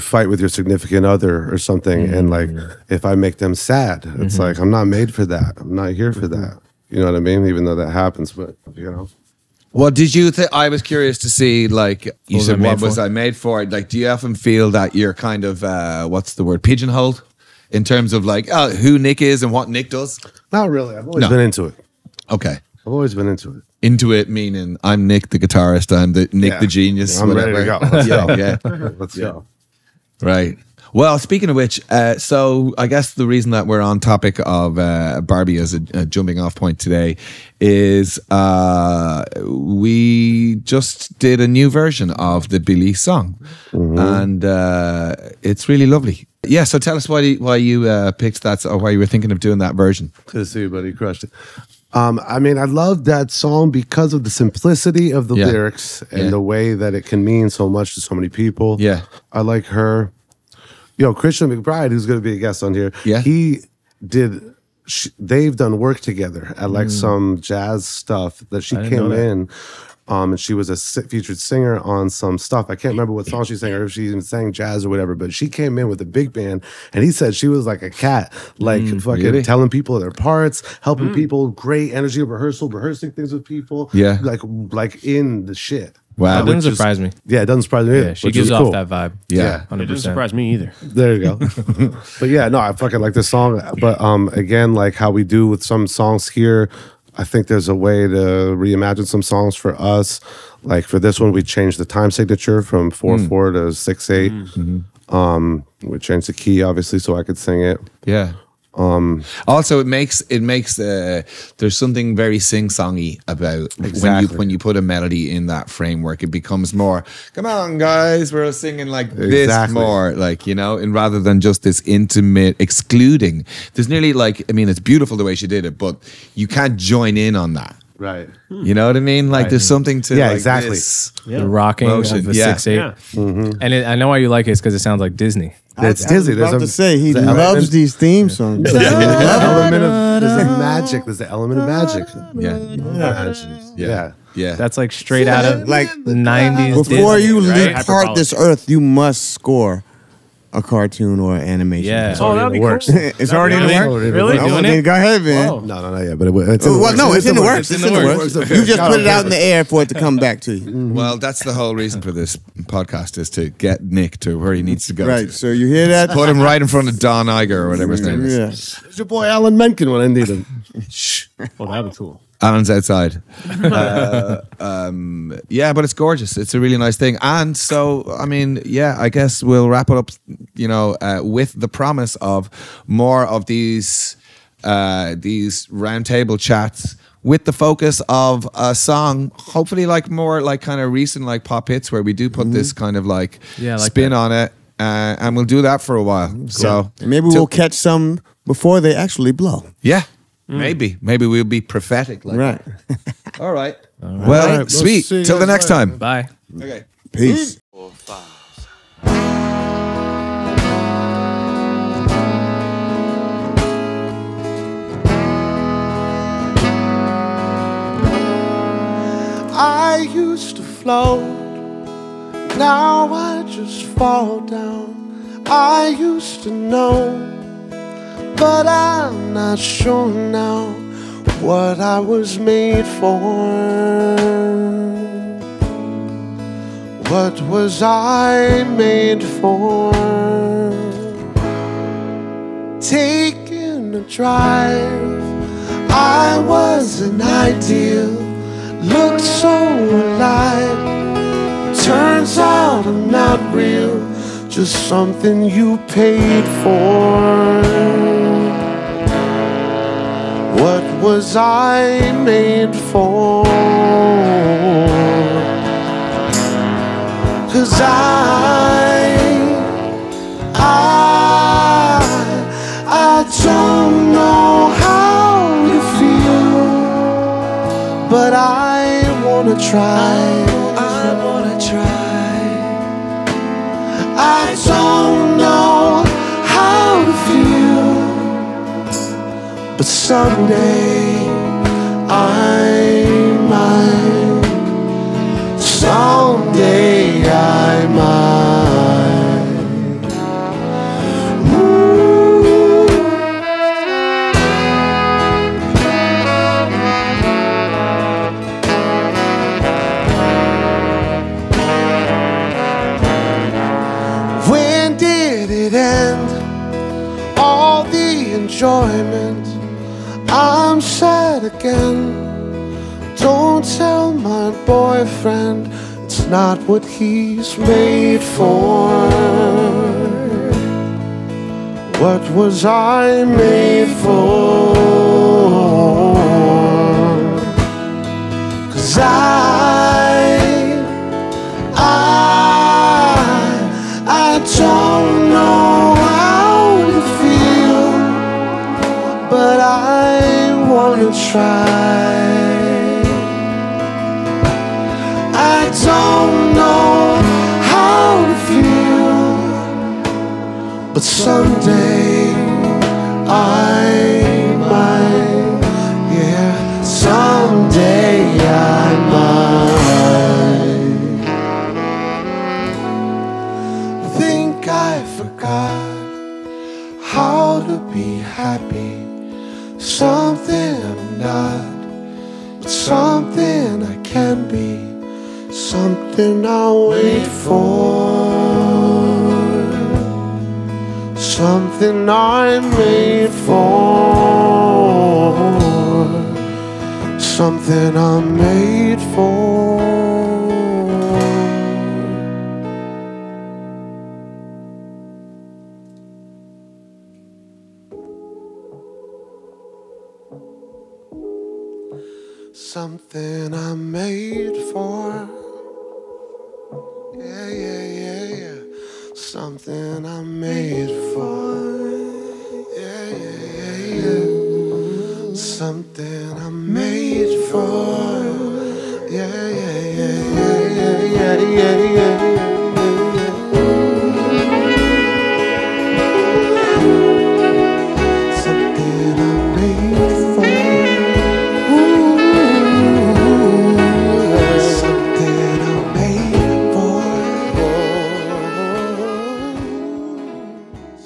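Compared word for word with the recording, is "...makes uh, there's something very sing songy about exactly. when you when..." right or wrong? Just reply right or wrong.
right.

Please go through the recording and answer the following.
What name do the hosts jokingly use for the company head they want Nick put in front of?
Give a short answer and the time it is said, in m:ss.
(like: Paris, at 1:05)
Don Iger, at 2:46.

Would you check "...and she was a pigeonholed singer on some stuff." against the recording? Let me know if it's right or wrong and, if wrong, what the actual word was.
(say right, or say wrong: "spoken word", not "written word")
wrong: "featured", not "pigeonholed".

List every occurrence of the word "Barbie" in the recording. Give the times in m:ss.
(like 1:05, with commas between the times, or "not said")
0:35.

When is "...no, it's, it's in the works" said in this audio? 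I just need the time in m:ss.
2:36.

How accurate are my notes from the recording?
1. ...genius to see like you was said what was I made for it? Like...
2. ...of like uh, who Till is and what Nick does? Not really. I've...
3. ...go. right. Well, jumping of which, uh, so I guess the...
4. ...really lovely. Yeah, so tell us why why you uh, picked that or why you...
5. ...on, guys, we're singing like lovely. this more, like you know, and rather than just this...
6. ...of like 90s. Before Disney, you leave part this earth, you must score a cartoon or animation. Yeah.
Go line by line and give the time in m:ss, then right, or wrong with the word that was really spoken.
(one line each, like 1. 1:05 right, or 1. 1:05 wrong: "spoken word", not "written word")
1. 0:10 wrong: "curious", not "genius"
2. 0:18 wrong: "Nick", not "Till"
3. 0:29 wrong: "speaking", not "jumping"
4. 0:45 right
5. 1:57 wrong: "exactly", not "lovely"
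6. 2:25 right.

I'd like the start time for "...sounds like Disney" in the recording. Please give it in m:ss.
2:14.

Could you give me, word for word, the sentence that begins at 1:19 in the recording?
telling people their parts, helping mm.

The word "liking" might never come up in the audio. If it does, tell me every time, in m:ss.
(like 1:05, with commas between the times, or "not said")
not said.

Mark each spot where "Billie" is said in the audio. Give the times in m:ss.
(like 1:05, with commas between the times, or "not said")
0:42.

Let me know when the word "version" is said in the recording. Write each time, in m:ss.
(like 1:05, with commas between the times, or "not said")
0:41, 0:49.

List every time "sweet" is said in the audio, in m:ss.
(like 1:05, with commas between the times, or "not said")
3:24.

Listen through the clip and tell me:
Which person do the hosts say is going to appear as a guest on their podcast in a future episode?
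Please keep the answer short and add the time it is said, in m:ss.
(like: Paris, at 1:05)
Christian McBride, at 1:01.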